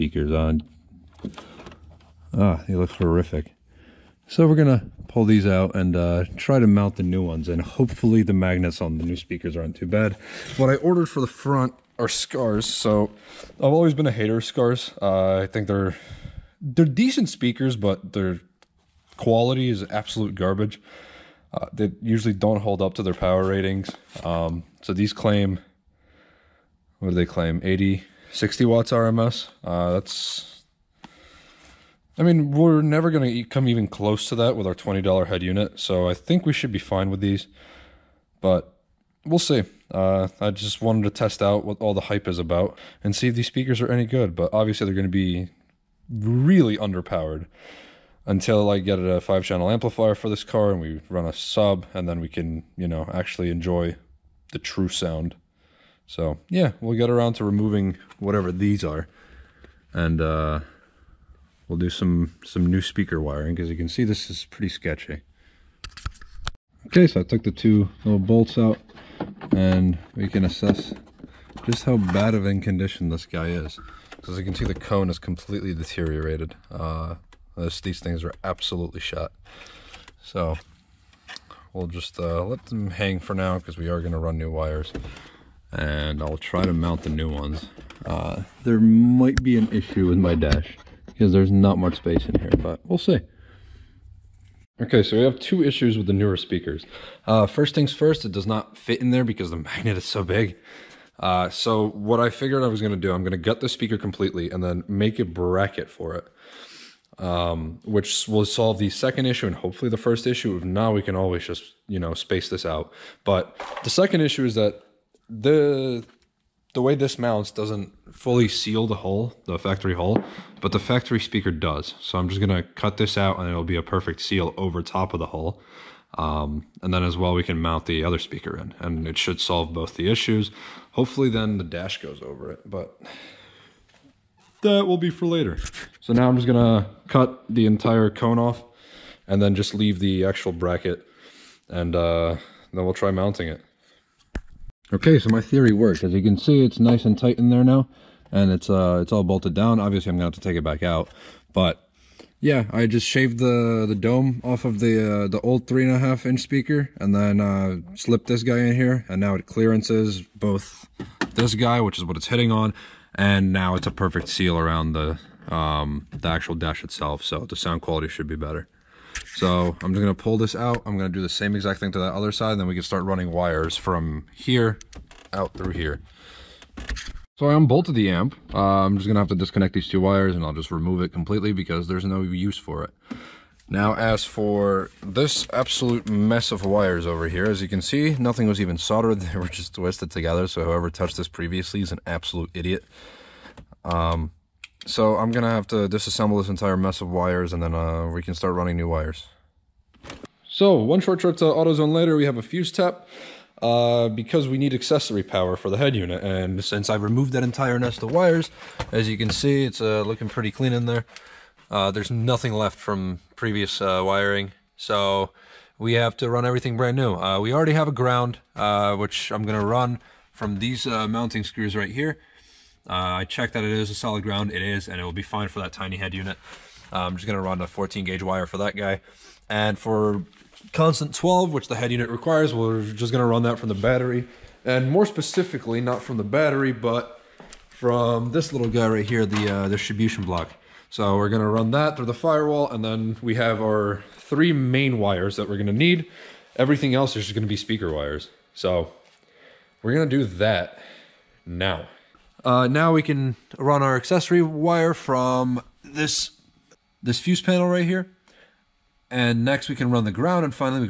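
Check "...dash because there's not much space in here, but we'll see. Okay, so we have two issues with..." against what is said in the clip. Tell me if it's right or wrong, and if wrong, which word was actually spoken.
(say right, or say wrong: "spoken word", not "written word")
right.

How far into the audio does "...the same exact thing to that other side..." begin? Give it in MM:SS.
02:51.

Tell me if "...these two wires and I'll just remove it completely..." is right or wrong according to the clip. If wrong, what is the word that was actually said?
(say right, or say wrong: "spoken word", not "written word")
right.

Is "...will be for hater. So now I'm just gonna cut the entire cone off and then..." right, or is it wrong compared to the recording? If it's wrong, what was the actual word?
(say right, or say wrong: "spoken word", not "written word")
wrong: "later", not "hater".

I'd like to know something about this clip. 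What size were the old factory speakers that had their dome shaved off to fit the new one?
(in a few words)
3.5 inch.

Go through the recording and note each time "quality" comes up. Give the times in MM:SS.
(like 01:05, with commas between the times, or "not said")
00:19, 02:47.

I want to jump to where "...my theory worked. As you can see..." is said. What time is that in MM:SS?
02:25.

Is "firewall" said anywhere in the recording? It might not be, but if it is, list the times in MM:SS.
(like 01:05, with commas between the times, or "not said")
04:02.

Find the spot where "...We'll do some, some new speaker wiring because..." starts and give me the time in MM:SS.
01:01.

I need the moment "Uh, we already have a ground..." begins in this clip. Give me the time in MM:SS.
03:37.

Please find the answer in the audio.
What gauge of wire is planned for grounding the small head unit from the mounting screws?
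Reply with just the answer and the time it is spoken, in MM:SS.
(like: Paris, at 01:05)
14 gauge, at 03:47.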